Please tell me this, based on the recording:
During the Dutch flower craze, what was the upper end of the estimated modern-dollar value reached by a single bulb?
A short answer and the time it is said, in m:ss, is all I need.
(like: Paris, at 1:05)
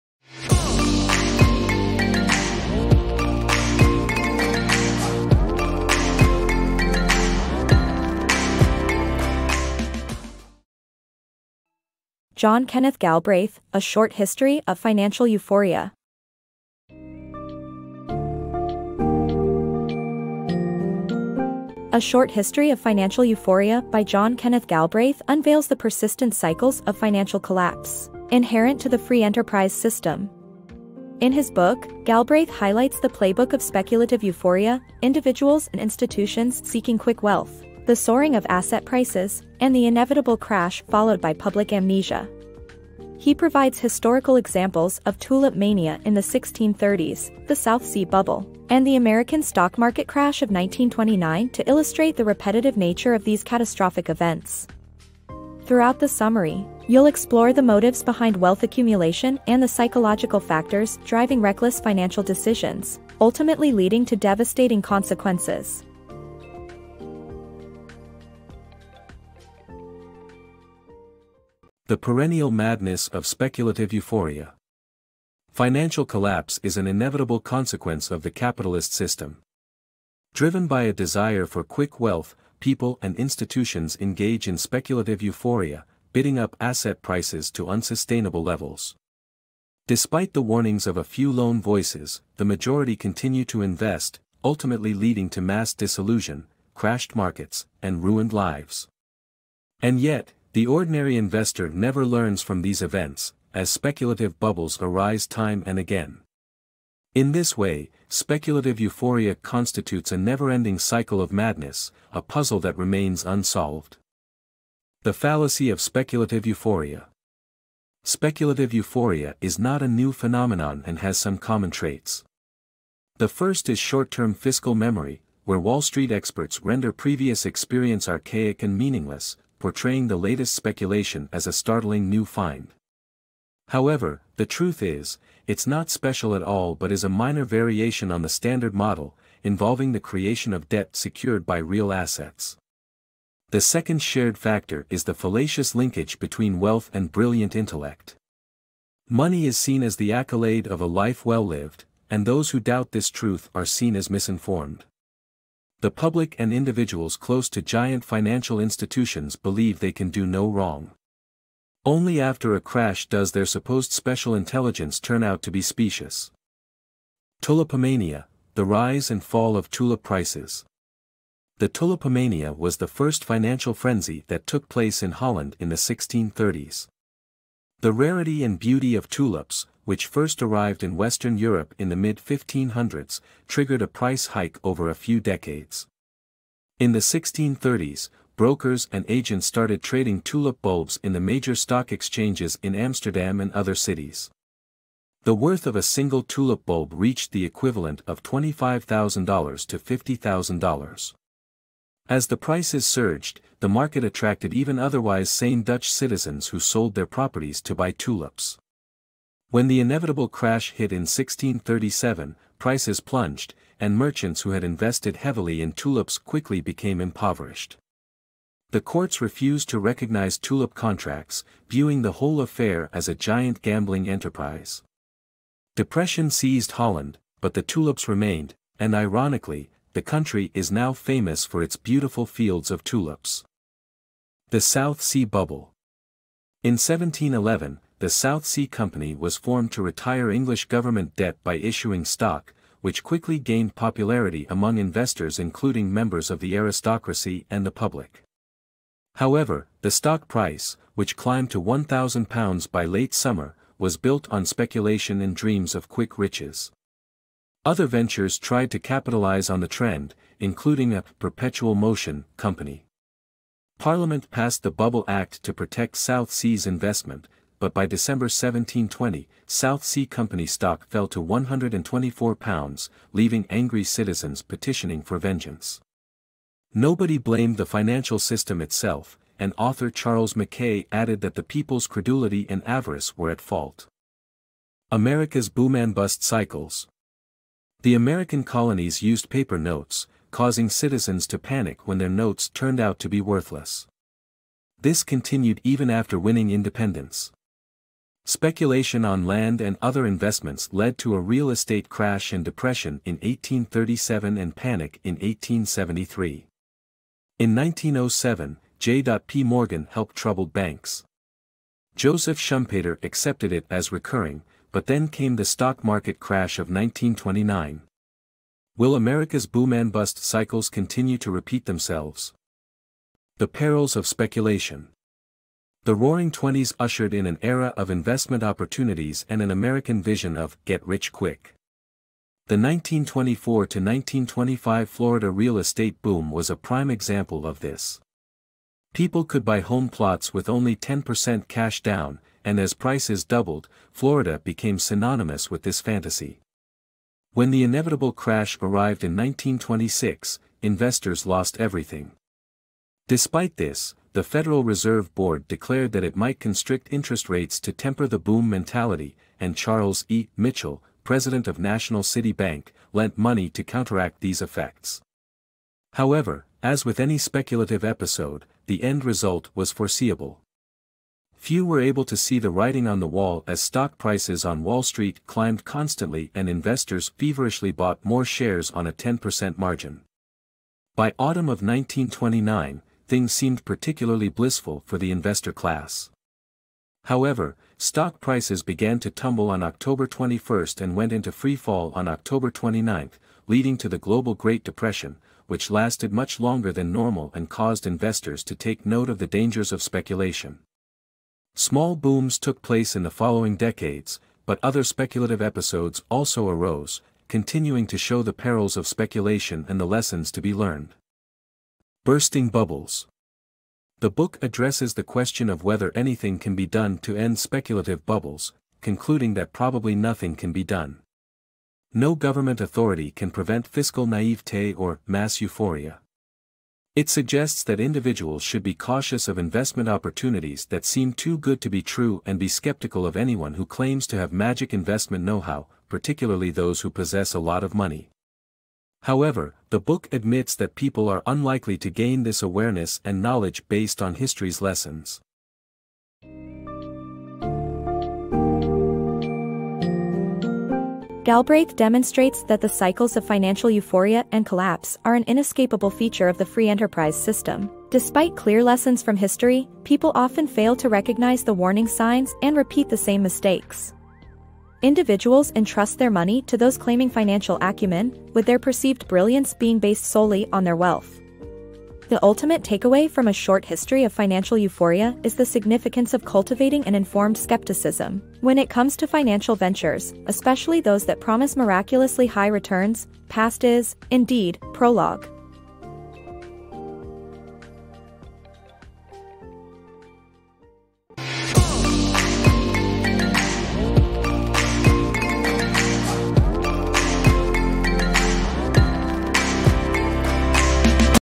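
$50,000, at 3:19.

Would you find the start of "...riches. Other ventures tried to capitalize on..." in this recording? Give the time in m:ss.
4:16.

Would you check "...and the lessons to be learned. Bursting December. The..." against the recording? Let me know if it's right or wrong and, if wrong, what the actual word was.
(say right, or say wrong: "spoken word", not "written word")
wrong: "Bubbles", not "December".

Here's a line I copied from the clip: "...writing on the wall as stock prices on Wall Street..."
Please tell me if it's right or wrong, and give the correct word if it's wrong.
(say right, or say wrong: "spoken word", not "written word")
right.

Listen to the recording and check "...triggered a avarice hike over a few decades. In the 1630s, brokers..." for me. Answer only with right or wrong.
wrong.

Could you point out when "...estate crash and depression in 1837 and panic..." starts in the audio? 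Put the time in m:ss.
5:01.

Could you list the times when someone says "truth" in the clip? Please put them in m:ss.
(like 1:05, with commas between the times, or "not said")
2:14, 2:33.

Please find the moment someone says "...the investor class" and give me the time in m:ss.
6:24.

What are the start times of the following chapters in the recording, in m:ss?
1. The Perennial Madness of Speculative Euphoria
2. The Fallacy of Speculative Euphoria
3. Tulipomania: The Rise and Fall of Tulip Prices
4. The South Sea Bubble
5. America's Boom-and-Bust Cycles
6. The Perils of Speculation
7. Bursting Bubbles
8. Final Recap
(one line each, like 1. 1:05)
1. 1:12
2. 1:55
3. 2:48
4. 3:55
5. 4:45
6. 5:24
7. 6:52
8. 7:26.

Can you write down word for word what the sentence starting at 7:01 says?
No government authority can prevent fiscal naivete or mass euphoria.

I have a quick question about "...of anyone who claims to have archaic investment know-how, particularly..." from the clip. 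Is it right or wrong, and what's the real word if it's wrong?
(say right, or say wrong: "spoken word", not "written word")
wrong: "magic", not "archaic".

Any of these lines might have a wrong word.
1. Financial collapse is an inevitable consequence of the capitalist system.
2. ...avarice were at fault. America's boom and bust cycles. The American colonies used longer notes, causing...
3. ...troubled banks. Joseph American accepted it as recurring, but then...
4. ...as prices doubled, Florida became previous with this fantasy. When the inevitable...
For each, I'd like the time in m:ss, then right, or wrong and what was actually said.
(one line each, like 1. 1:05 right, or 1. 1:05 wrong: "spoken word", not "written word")
1. 1:15 right
2. 4:42 wrong: "paper", not "longer"
3. 5:10 wrong: "Schumpeter", not "American"
4. 5:42 wrong: "synonymous", not "previous".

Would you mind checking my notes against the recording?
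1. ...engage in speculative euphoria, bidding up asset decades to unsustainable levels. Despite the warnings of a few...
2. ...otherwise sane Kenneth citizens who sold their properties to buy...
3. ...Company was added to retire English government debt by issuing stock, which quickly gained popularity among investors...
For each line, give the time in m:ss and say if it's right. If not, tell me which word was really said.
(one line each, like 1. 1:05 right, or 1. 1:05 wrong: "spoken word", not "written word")
1. 1:23 wrong: "prices", not "decades"
2. 3:24 wrong: "Dutch", not "Kenneth"
3. 3:58 wrong: "formed", not "added".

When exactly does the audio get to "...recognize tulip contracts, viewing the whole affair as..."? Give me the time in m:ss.
3:39.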